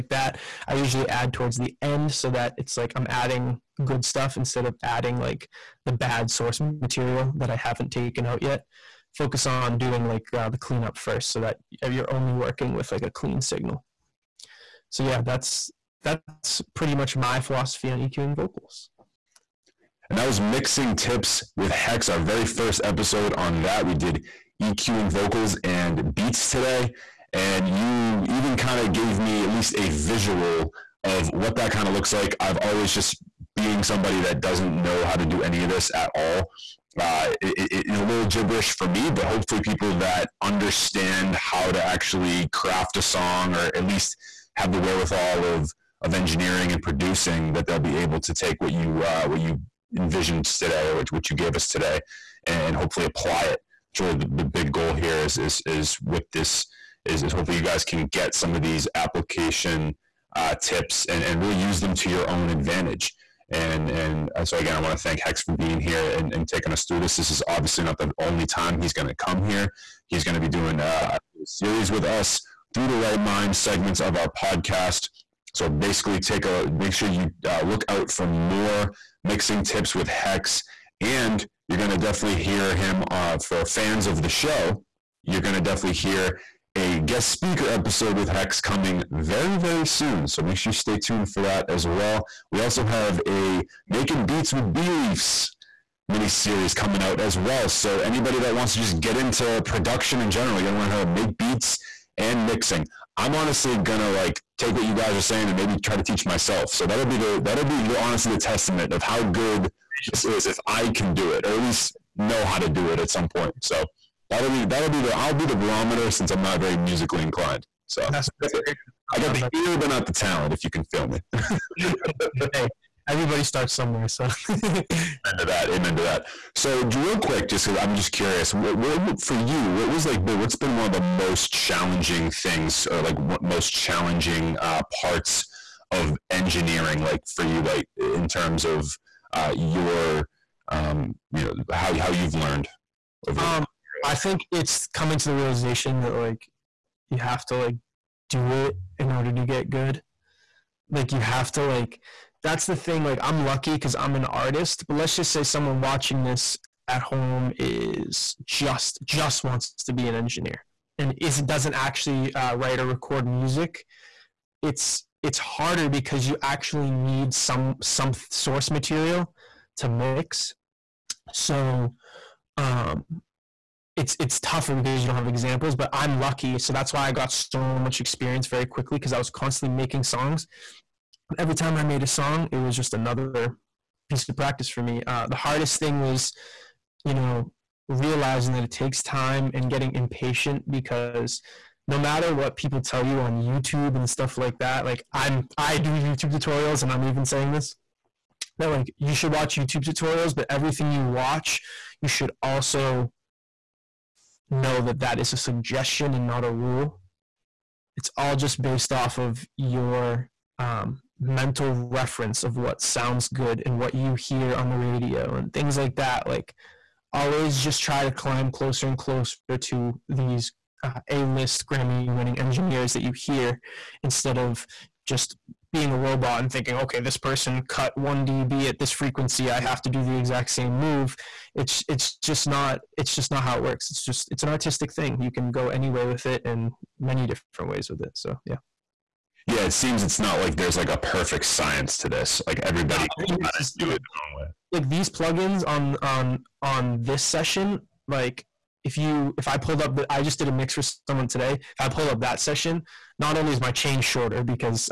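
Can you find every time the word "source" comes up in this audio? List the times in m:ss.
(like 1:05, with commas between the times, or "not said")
0:06, 2:48.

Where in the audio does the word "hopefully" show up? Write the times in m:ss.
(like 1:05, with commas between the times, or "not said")
0:39, 0:52, 0:57.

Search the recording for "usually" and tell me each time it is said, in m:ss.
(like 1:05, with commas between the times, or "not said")
0:00.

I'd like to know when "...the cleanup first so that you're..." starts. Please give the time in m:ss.
0:10.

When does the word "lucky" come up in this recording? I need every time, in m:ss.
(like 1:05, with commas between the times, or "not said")
2:33, 2:56.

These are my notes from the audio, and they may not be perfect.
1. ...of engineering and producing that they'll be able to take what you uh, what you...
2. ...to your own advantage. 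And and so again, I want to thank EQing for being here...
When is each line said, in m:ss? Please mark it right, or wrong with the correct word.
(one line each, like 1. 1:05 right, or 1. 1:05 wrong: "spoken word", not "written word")
1. 0:46 right
2. 1:01 wrong: "Hex", not "EQing".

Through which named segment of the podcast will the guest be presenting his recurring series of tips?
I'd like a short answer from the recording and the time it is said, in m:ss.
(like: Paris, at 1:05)
Write Mind, at 1:12.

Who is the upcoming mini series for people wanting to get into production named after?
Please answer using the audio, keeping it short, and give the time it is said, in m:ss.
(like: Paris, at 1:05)
Bee Leafs, at 1:34.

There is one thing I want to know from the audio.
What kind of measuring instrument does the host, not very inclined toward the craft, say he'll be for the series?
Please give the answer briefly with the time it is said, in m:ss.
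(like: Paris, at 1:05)
barometer, at 1:55.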